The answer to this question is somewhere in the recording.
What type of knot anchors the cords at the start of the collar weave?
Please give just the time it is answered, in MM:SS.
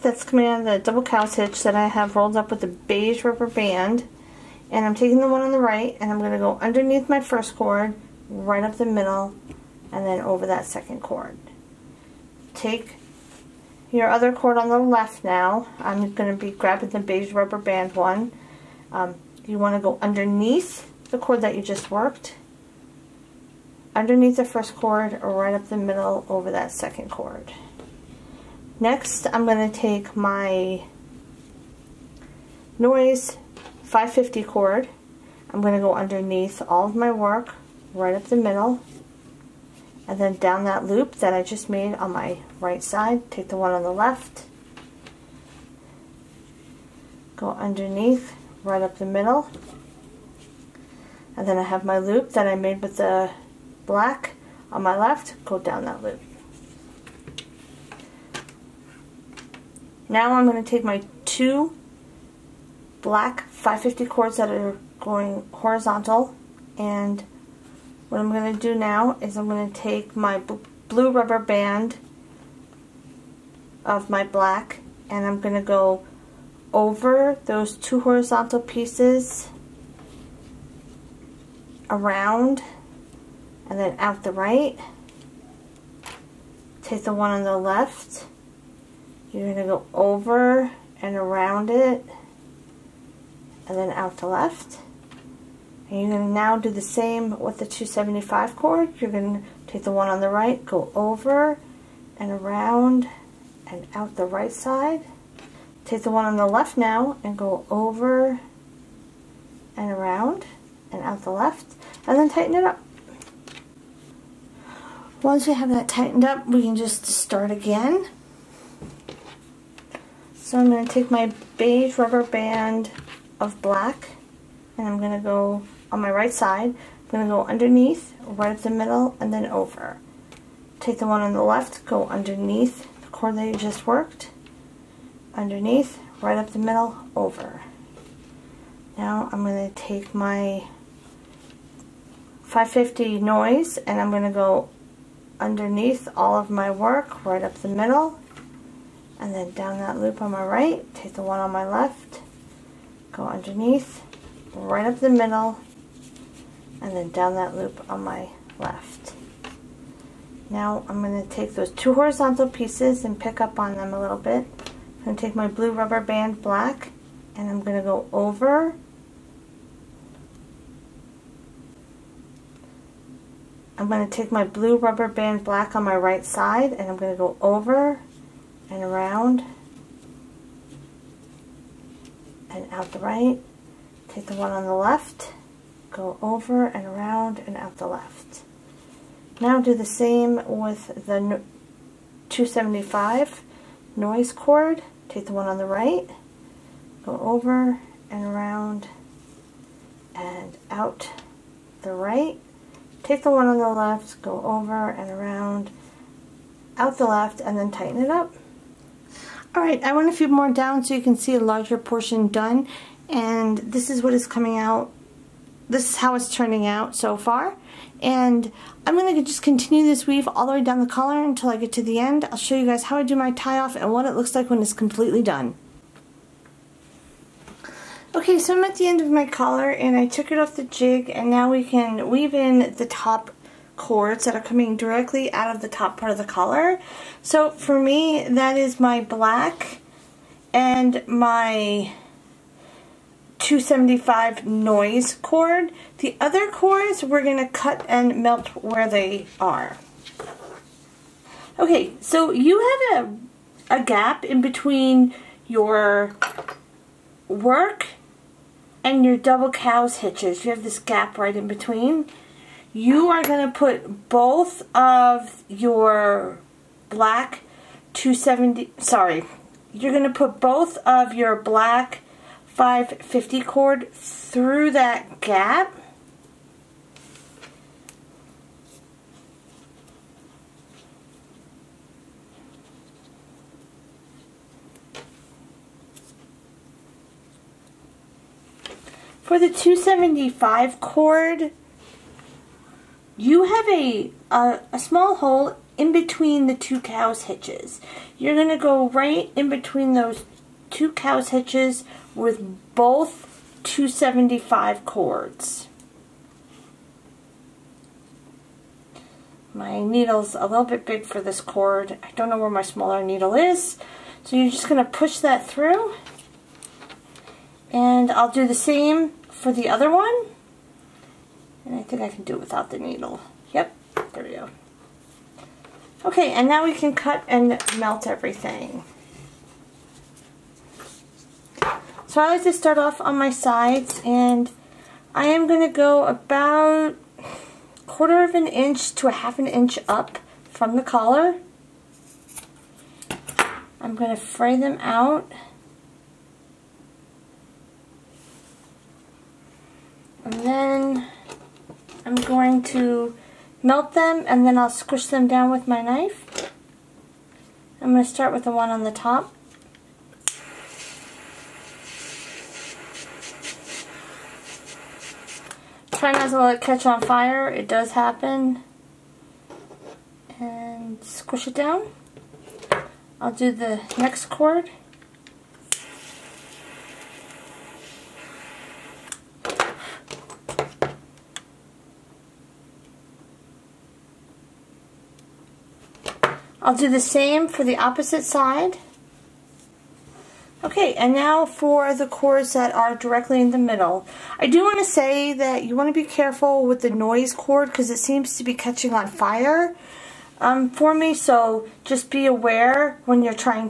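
00:00.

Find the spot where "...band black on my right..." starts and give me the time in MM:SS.
02:55.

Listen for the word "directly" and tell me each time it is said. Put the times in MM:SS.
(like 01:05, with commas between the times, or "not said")
03:54, 06:32.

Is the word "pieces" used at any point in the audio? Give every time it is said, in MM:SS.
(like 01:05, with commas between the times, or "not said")
01:18, 02:42.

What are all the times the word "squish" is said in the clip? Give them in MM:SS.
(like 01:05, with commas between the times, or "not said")
05:54, 06:11.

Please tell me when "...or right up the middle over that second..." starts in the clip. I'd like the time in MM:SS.
00:25.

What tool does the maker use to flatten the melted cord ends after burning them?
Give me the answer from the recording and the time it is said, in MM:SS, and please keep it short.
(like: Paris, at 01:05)
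knife, at 05:55.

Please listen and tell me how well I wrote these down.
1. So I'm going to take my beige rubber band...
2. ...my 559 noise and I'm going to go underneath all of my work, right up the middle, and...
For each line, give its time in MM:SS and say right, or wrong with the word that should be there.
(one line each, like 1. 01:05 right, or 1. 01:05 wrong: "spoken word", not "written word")
1. 02:00 right
2. 02:20 wrong: "550", not "559".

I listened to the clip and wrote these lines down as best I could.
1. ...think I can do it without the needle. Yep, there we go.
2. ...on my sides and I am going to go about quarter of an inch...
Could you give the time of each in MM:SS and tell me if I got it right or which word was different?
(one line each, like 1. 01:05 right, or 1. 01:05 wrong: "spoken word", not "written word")
1. 05:21 right
2. 05:32 right.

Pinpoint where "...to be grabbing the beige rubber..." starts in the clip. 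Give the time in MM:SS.
00:16.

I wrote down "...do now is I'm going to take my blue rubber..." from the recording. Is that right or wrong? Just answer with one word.
right.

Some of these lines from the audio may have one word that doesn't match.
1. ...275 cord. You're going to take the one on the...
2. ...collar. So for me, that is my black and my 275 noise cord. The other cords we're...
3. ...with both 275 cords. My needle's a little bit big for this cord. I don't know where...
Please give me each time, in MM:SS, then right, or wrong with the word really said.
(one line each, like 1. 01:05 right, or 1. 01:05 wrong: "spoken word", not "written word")
1. 01:37 right
2. 03:56 right
3. 05:02 right.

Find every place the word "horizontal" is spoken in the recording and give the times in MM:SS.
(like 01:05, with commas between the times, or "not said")
01:05, 01:17, 02:41.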